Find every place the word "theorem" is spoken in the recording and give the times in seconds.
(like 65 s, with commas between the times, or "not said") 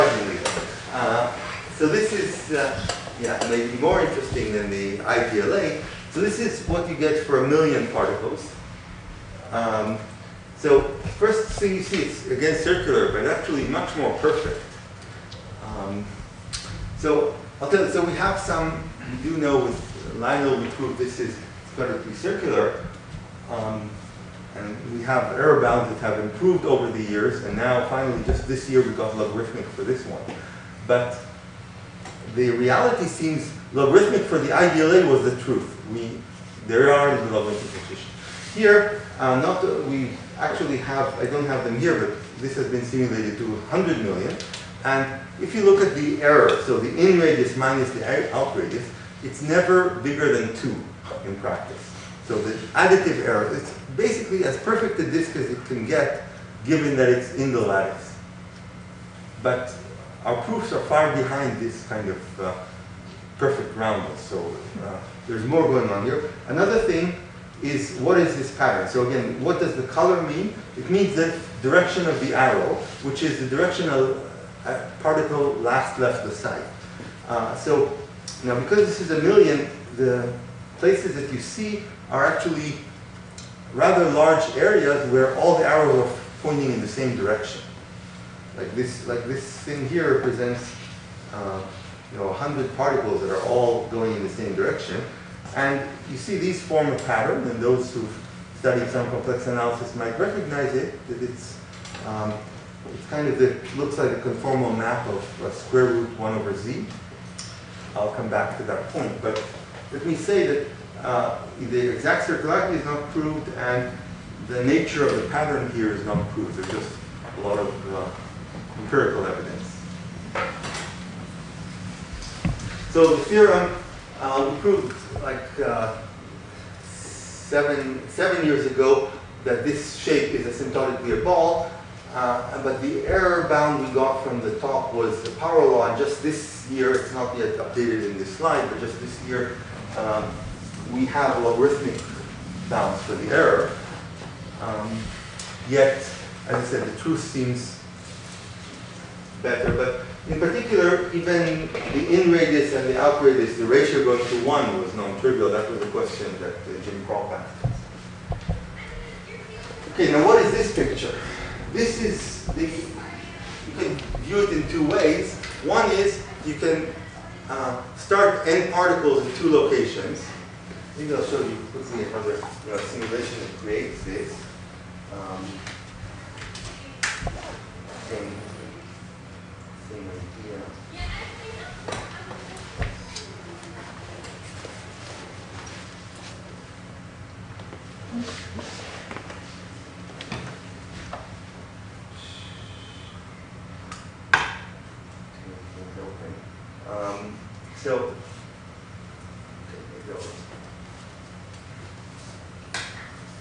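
123 s.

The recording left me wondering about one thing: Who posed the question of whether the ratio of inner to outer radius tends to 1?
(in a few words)
Jim Kroll.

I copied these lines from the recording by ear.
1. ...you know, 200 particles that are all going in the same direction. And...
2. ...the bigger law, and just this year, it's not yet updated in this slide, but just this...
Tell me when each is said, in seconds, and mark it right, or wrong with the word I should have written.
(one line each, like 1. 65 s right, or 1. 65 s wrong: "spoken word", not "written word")
1. 92 s wrong: "100", not "200"
2. 135 s wrong: "power", not "bigger".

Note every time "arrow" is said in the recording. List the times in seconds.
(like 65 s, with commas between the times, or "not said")
72 s, 85 s.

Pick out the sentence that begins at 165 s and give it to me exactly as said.
One is you can uh, start n particles in two locations.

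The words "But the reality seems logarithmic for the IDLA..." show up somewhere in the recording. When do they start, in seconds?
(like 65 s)
30 s.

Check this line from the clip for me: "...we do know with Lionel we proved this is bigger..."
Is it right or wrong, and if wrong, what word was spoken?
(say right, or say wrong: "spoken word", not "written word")
wrong: "better", not "bigger".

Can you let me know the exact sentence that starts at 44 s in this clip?
And if you look at the error, so the in radius minus the out radius, it's never bigger than 2 in practice.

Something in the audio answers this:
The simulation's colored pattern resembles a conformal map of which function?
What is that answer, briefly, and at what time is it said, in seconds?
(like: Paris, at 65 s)
square root 1 over z, at 105 s.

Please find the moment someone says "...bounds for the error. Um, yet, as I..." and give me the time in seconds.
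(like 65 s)
142 s.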